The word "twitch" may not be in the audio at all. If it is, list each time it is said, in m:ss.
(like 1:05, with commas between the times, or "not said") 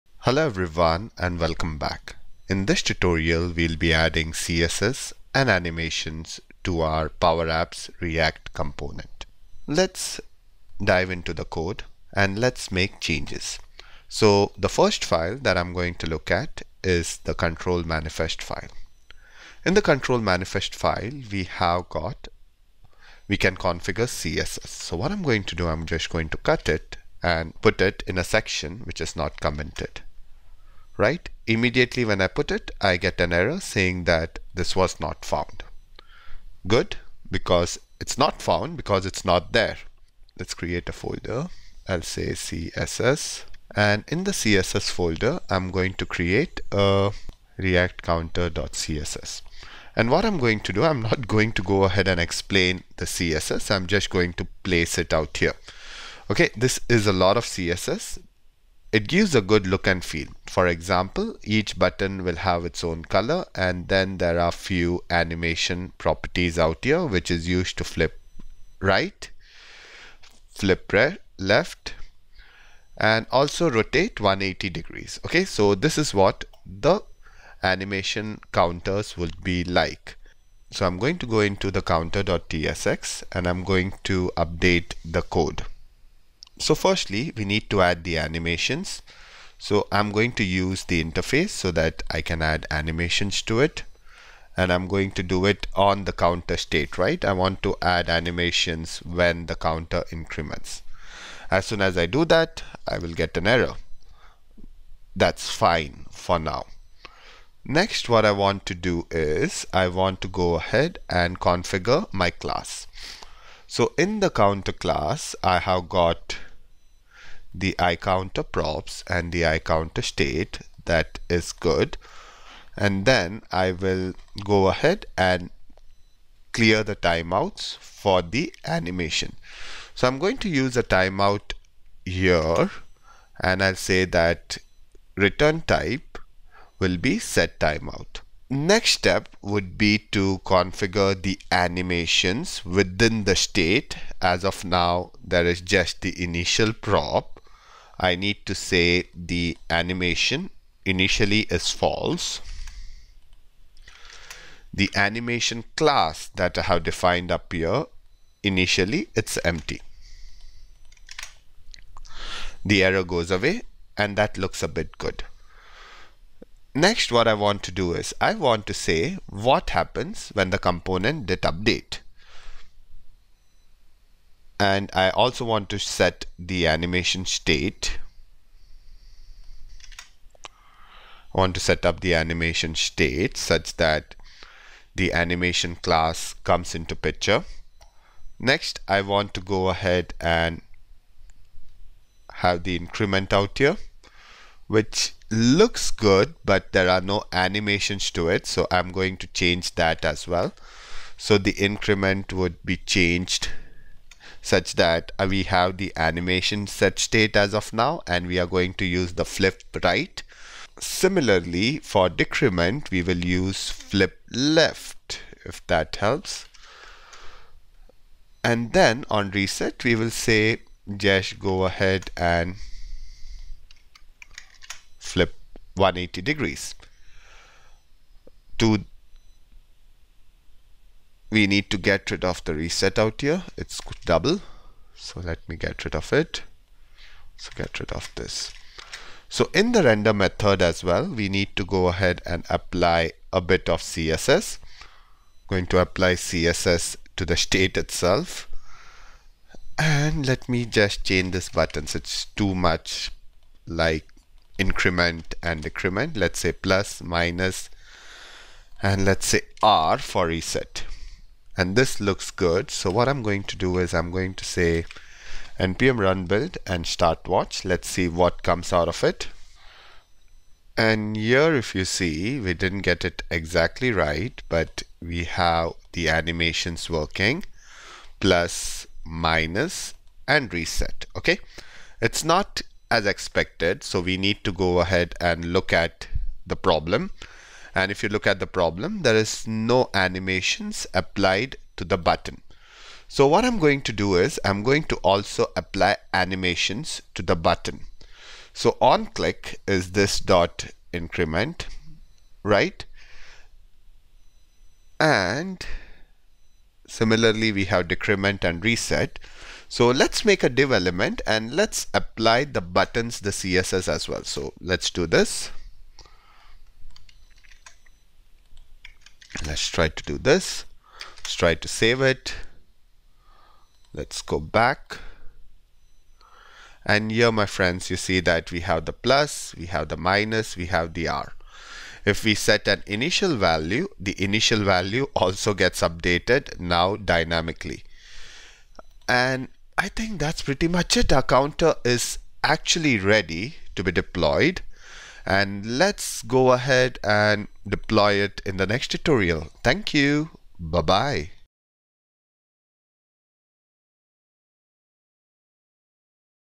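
not said.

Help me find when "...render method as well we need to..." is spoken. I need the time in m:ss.
3:59.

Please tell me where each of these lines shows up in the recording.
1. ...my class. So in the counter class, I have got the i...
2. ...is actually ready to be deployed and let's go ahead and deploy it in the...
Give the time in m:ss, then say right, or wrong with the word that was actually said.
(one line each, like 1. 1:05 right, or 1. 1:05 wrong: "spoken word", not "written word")
1. 1:52 right
2. 5:41 right.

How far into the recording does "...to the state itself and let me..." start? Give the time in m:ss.
4:07.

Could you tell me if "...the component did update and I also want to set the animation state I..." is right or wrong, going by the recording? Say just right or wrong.
right.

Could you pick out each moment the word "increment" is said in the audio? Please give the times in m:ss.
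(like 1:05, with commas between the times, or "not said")
1:40, 3:12, 3:21, 4:14, 5:00.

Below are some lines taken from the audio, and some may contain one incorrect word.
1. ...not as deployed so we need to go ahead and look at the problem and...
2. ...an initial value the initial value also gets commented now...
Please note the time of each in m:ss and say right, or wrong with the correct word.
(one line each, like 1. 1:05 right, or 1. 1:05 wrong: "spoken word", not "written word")
1. 4:42 wrong: "expected", not "deployed"
2. 5:32 wrong: "updated", not "commented".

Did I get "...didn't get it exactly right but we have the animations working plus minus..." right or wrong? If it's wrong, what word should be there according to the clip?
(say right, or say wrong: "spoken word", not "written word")
right.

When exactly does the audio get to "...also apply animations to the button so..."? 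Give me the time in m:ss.
4:54.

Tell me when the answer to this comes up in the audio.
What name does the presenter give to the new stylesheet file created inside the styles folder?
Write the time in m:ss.
0:47.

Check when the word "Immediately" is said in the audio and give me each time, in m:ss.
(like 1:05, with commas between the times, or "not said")
0:31.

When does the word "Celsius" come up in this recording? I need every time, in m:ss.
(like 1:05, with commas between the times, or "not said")
not said.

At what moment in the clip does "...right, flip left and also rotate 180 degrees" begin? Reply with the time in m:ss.
1:08.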